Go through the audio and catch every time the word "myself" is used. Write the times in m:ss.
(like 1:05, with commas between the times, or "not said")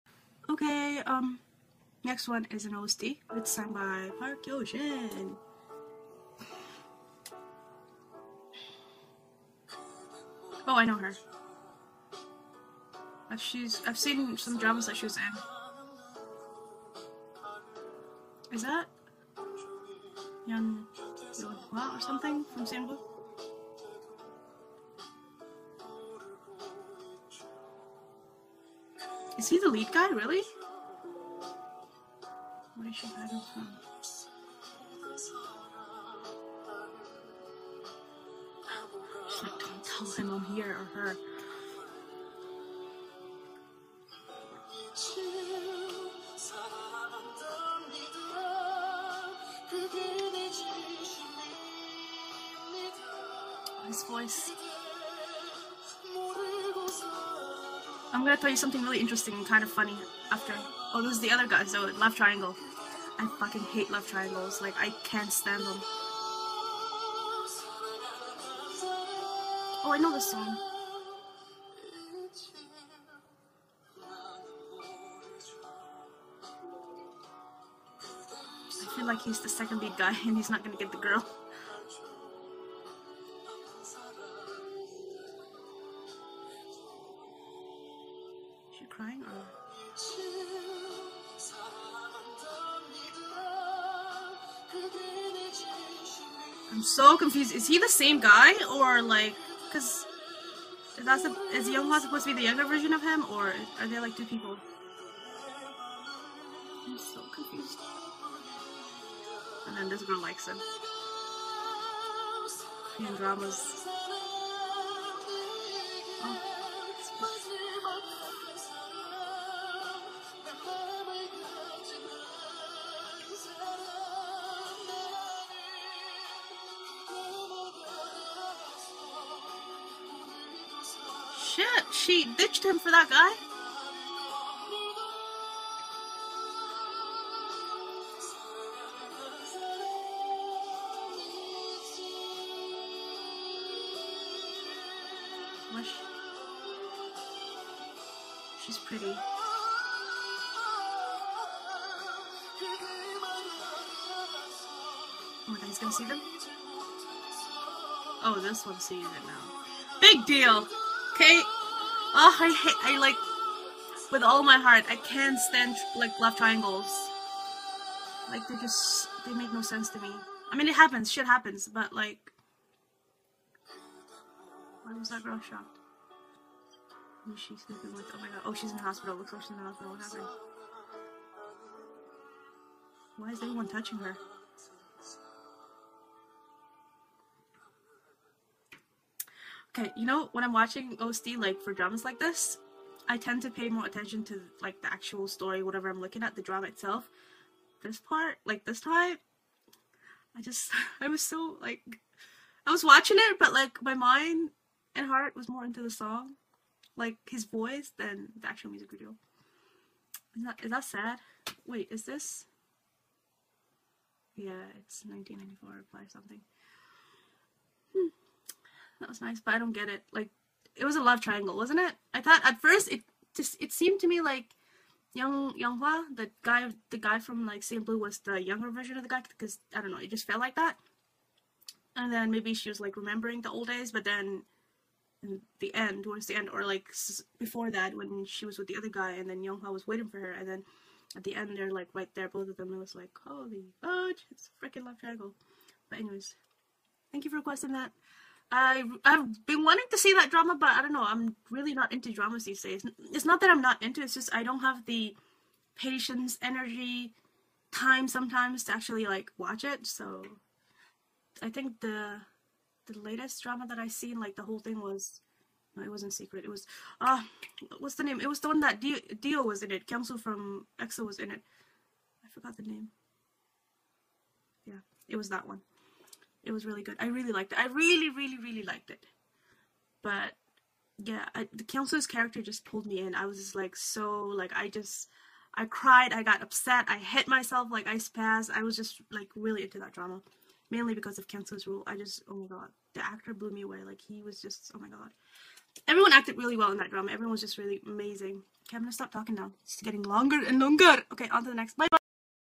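4:47.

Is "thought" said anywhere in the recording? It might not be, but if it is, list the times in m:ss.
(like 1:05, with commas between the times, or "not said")
3:42.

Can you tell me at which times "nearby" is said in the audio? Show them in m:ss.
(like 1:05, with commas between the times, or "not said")
not said.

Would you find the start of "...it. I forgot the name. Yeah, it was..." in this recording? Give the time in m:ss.
4:31.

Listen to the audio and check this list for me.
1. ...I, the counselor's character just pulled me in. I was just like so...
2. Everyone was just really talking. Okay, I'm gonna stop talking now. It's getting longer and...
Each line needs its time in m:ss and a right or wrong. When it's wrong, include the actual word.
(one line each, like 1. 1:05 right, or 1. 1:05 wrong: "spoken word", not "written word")
1. 4:41 right
2. 4:57 wrong: "amazing", not "talking".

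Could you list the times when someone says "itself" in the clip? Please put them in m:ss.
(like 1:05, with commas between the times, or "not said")
3:16.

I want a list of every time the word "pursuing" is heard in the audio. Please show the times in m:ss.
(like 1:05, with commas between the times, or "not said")
not said.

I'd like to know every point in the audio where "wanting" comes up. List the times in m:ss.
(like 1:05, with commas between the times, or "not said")
4:09.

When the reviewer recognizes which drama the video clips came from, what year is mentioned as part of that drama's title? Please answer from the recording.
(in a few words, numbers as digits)
1994.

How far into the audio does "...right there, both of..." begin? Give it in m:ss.
4:01.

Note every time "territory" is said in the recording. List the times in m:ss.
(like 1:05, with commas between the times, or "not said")
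not said.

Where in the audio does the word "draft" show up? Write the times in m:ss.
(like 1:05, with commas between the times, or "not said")
not said.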